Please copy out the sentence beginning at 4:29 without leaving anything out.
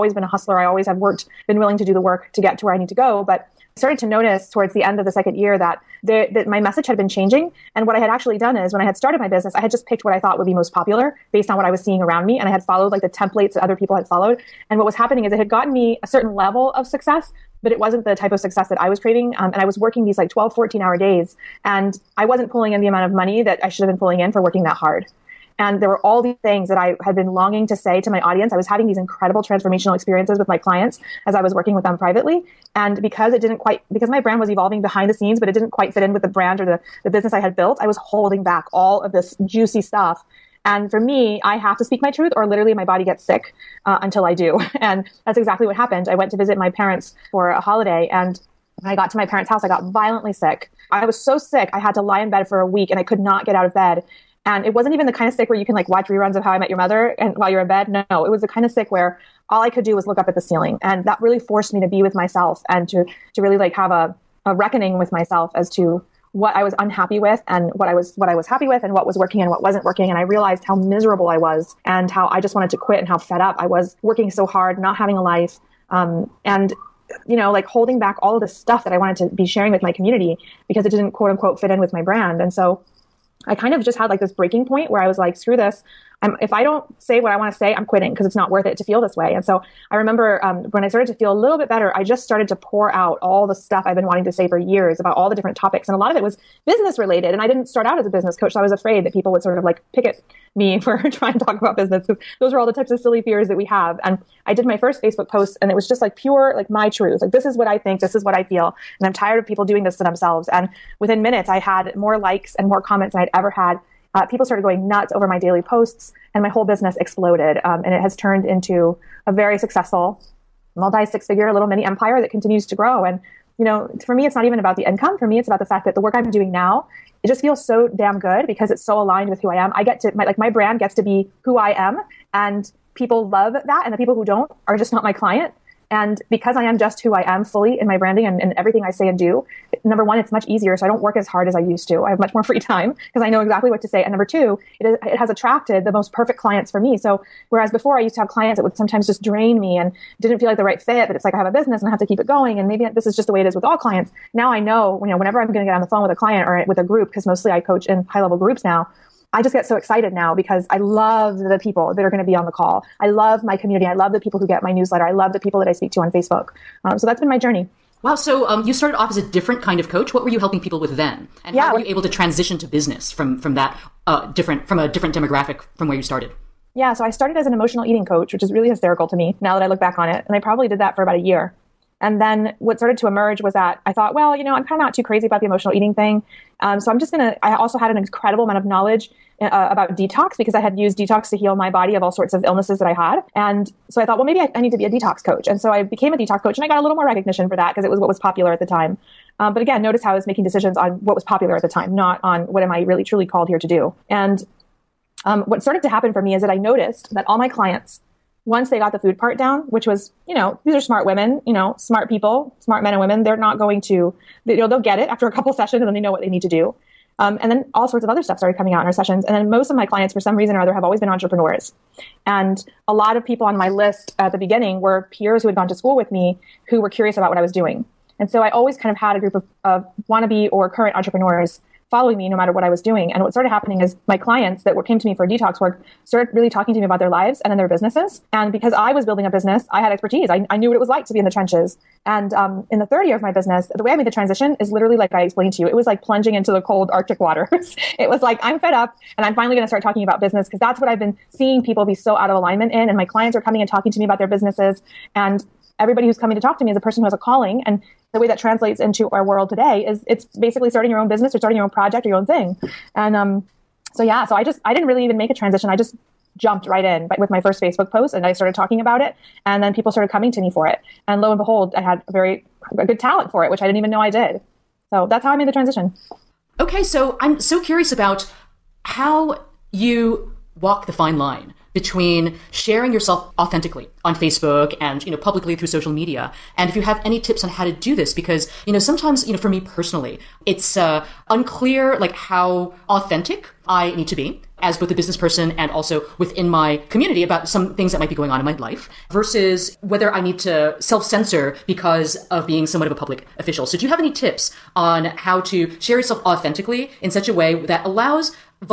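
And then people started coming to me for it.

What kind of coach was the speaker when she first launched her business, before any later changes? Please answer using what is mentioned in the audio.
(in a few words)
Emotional eating coach.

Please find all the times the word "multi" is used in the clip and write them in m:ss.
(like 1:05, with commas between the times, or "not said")
2:00.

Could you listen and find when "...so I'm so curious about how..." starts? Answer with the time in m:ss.
4:36.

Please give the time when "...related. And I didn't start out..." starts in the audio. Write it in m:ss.
1:36.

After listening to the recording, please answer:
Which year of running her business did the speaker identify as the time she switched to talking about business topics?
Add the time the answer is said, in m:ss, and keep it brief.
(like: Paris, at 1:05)
Third year, at 4:02.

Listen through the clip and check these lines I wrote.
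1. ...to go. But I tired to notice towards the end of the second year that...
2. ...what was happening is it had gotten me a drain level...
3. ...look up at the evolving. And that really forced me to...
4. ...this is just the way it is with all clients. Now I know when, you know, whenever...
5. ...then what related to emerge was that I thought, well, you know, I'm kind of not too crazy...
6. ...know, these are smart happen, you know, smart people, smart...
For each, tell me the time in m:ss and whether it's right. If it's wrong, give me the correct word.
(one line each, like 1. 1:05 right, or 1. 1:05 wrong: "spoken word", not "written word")
1. 0:02 wrong: "started", not "tired"
2. 0:14 wrong: "certain", not "drain"
3. 1:00 wrong: "ceiling", not "evolving"
4. 2:32 right
5. 3:02 wrong: "started", not "related"
6. 3:30 wrong: "women", not "happen".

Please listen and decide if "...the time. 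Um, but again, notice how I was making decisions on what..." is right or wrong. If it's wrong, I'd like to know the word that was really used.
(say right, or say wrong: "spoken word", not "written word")
right.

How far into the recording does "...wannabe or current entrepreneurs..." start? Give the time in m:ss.
3:50.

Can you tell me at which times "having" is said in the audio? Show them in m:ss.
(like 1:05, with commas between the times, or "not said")
0:28, 1:14.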